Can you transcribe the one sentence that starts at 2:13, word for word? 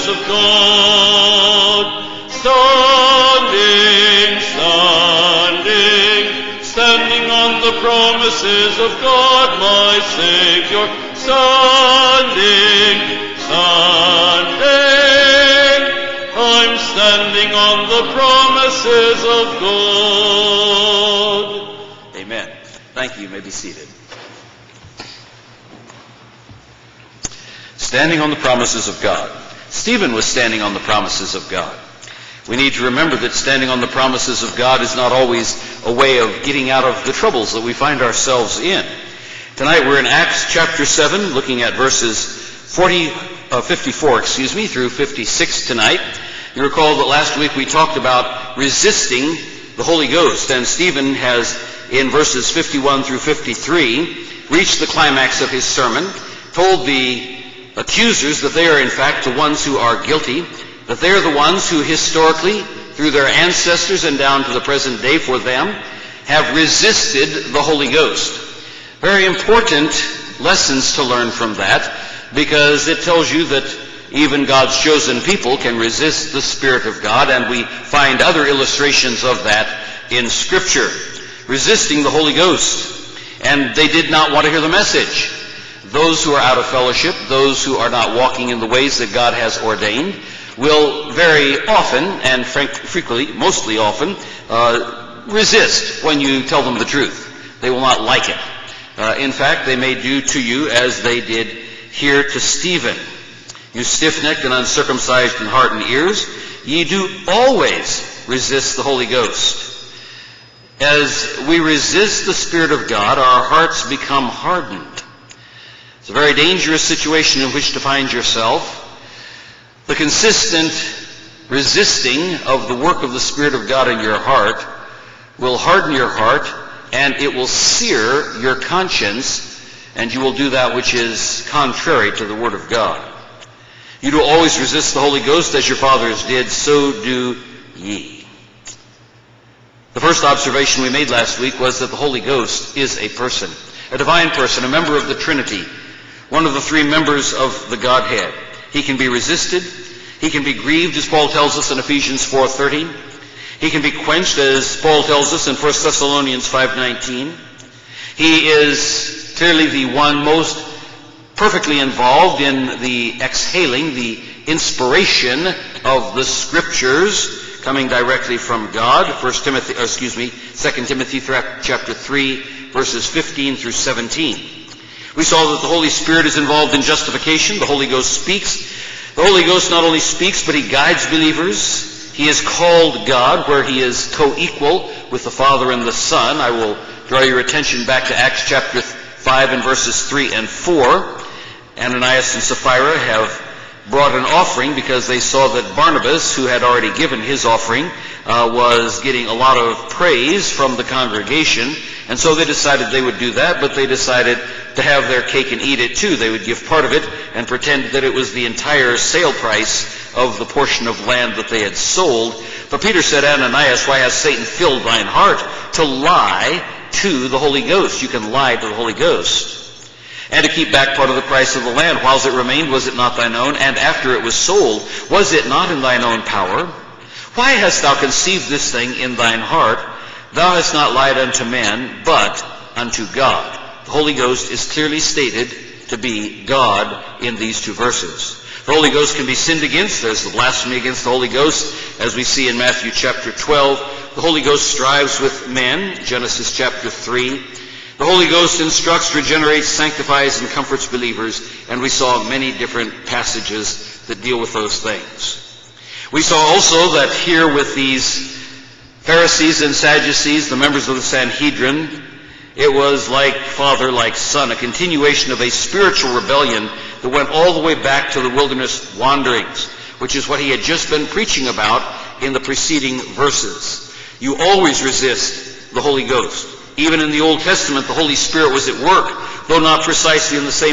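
You do always resist the Holy Ghost as your fathers did, so do ye.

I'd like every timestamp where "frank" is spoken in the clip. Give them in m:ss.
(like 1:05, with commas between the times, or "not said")
1:32.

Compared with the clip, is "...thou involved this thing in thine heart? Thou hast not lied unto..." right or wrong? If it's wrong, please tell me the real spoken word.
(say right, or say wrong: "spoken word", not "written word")
wrong: "conceived", not "involved".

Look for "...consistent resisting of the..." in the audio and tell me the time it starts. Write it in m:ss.
1:59.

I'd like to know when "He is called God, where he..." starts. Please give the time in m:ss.
3:02.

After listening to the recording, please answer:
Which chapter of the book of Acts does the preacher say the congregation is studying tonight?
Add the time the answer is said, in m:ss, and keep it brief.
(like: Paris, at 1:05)
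Chapter 7, at 0:40.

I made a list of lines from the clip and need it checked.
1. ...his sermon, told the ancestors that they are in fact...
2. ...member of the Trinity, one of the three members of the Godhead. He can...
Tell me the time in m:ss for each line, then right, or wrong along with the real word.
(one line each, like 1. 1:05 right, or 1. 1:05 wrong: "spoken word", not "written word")
1. 0:55 wrong: "accusers", not "ancestors"
2. 2:24 right.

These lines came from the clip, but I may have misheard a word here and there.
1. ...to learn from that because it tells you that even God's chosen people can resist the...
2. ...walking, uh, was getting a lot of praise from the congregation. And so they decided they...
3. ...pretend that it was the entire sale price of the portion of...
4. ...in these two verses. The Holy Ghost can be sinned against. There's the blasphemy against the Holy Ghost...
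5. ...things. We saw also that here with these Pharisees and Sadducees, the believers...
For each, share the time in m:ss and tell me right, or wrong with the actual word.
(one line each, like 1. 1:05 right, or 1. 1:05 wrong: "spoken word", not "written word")
1. 1:10 right
2. 3:17 wrong: "offering", not "walking"
3. 3:27 right
4. 3:57 right
5. 4:14 wrong: "members", not "believers".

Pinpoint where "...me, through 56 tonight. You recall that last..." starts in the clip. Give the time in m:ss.
0:44.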